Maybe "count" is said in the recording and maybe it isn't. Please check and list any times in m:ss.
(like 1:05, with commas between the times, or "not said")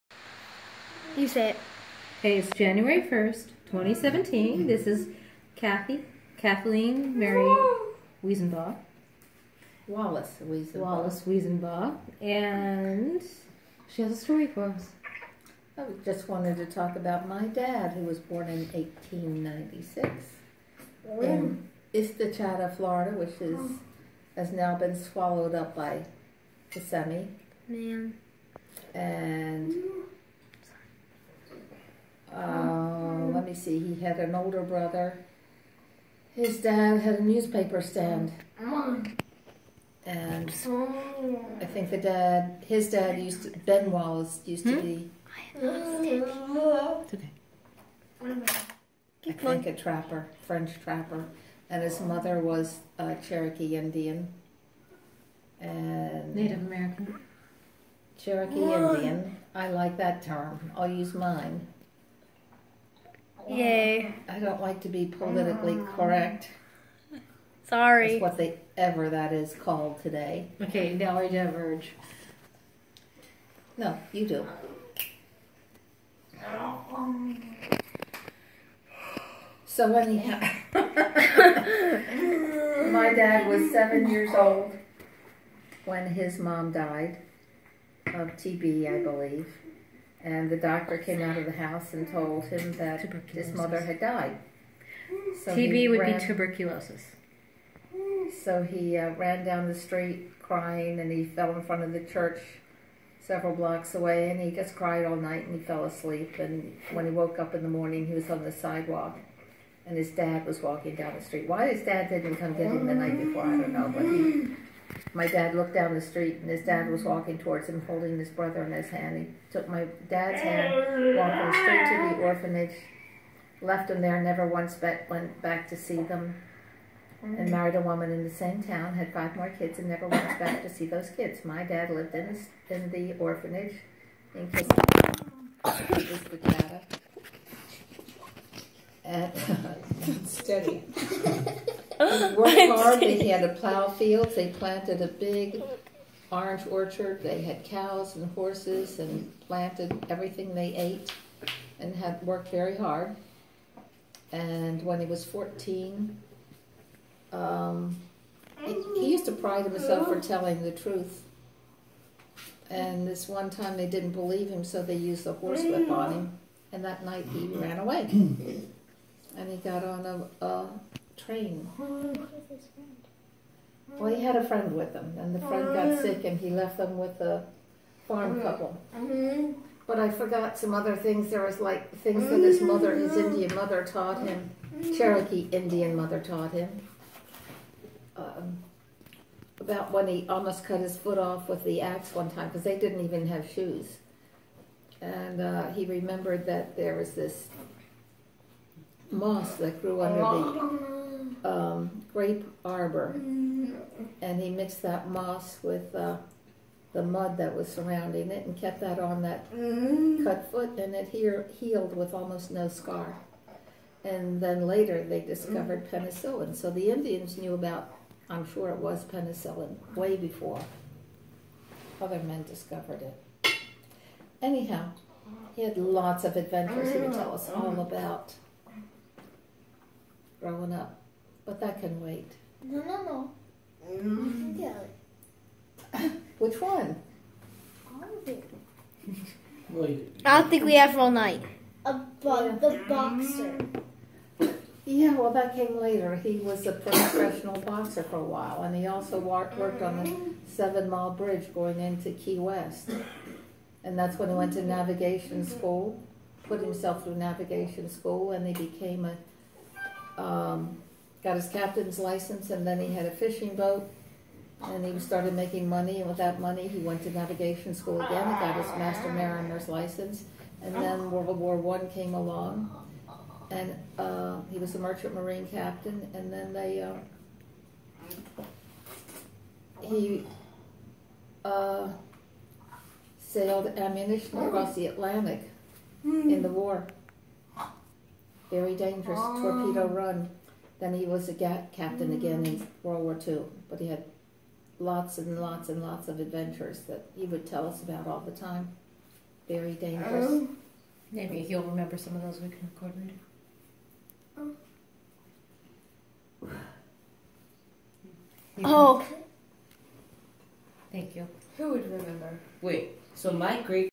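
not said.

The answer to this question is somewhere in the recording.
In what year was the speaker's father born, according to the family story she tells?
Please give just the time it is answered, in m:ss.
0:18.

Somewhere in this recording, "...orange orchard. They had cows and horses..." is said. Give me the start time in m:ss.
2:26.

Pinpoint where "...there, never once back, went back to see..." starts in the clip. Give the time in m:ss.
2:04.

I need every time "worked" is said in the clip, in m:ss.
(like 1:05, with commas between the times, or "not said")
2:22, 2:32, 4:09.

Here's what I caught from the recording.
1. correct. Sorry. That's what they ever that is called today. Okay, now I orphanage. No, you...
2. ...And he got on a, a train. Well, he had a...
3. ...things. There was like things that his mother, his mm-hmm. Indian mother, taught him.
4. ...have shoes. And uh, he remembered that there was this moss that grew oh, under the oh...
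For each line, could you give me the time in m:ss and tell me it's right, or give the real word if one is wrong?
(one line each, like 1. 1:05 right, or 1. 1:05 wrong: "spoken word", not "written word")
1. 1:05 wrong: "diverge", not "orphanage"
2. 2:49 right
3. 3:00 right
4. 3:13 right.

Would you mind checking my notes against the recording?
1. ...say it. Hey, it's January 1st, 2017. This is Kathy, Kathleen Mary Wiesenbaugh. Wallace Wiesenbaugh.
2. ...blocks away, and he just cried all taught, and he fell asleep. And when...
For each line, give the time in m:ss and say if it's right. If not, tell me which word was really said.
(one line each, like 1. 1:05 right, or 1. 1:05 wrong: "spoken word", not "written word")
1. 0:01 right
2. 1:43 wrong: "night", not "taught".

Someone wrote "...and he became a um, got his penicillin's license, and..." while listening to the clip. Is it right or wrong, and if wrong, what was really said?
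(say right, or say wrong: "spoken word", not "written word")
wrong: "captain", not "penicillin".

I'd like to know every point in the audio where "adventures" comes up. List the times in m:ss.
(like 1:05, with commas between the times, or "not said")
3:46, 4:56.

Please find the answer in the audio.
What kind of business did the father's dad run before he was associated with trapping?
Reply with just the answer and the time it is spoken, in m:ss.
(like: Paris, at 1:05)
Newspaper stand, at 0:37.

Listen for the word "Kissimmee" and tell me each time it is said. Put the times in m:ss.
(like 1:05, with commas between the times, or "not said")
0:26, 2:14.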